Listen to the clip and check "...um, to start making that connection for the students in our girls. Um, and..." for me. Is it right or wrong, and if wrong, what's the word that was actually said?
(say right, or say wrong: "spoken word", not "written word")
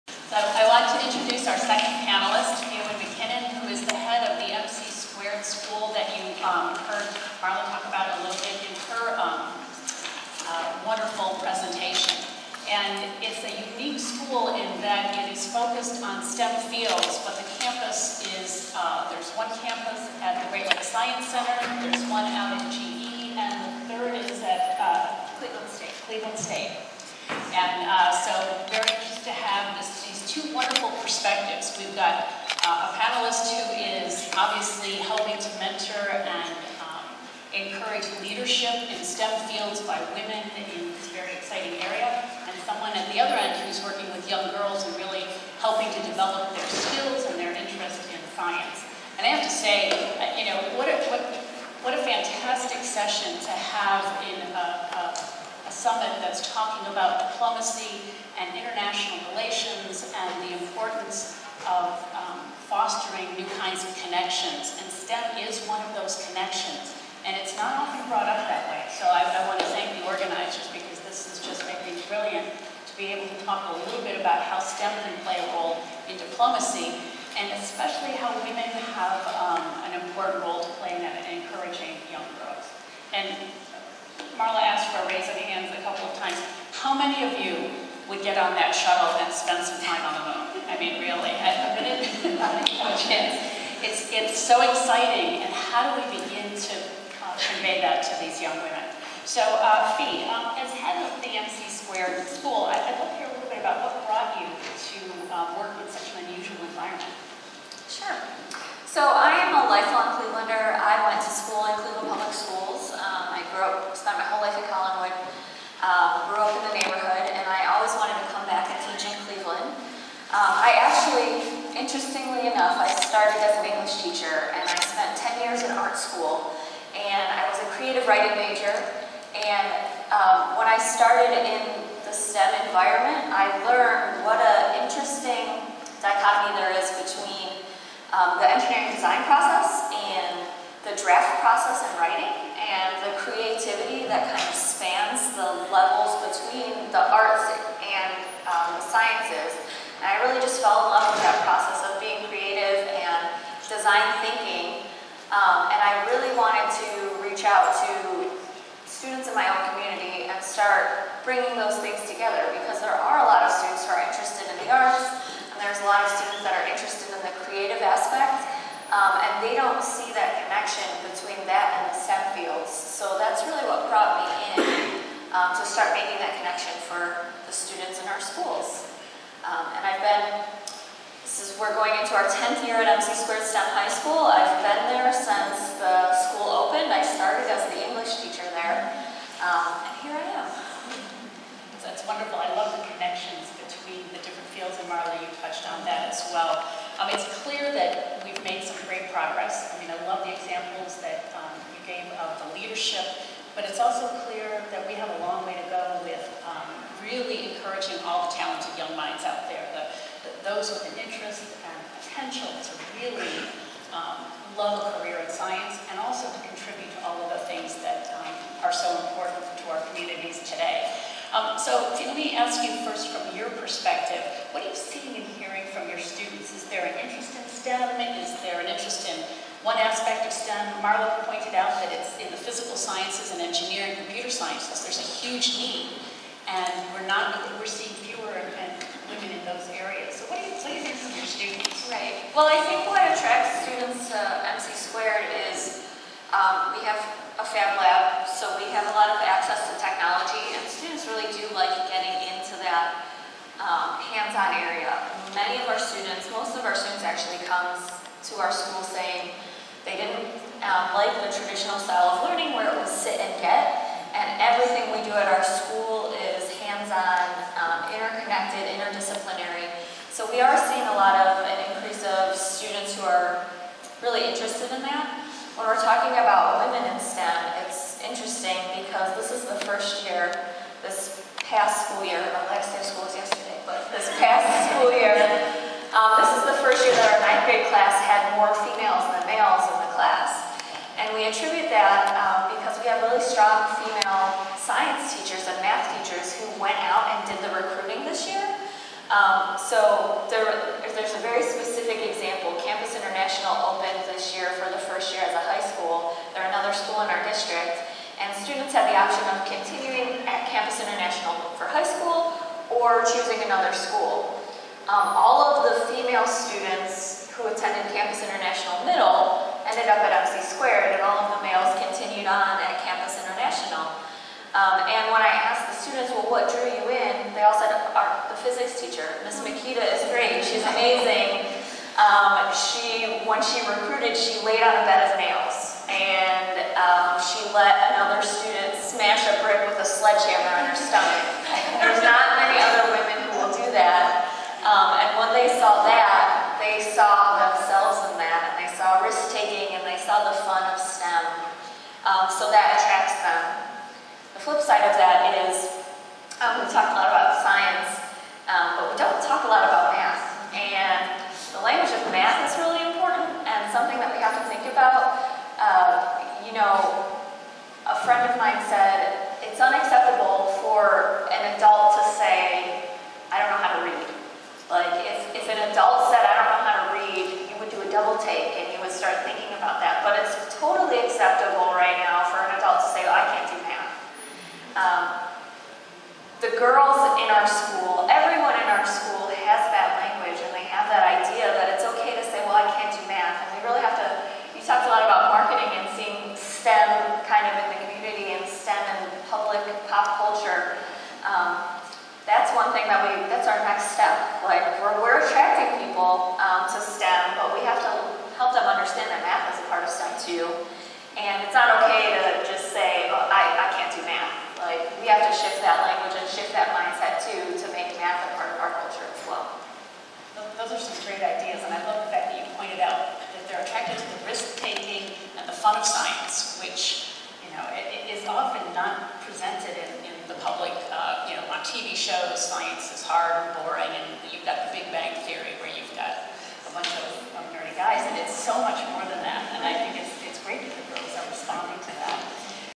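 wrong: "schools", not "girls".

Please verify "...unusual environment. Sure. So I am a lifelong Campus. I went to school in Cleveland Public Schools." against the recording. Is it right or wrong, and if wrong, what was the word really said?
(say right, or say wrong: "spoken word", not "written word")
wrong: "Clevelander", not "Campus".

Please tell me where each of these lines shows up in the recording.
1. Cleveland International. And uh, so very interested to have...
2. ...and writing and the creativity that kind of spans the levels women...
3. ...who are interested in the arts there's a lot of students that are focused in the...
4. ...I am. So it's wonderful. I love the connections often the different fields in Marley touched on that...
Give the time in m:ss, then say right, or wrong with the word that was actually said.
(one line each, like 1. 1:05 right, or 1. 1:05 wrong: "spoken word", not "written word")
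1. 0:26 wrong: "State", not "International"
2. 2:21 wrong: "between", not "women"
3. 2:43 wrong: "interested", not "focused"
4. 3:10 wrong: "between", not "often".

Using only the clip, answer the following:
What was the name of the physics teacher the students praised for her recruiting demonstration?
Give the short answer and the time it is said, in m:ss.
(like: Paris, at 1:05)
Miss Makita, at 5:29.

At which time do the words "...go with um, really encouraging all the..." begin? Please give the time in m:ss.
3:25.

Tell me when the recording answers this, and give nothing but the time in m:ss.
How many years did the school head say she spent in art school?
2:05.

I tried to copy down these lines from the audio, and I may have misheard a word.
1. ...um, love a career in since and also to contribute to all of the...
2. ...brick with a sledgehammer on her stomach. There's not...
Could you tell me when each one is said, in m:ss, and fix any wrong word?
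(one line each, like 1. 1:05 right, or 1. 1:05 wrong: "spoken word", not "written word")
1. 3:33 wrong: "science", not "since"
2. 5:39 right.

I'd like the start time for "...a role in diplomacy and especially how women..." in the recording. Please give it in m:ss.
1:15.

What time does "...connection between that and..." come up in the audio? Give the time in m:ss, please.
2:50.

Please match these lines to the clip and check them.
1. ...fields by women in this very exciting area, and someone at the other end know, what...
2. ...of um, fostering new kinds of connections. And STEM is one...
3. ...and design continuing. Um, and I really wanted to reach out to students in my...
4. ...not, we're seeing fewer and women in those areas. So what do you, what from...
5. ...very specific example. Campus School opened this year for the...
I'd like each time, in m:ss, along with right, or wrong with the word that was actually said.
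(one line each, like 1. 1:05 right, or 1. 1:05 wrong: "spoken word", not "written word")
1. 0:39 right
2. 1:01 right
3. 2:32 wrong: "thinking", not "continuing"
4. 3:57 right
5. 5:01 wrong: "International", not "School".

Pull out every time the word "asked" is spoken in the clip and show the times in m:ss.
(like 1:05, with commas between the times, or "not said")
1:24, 5:25.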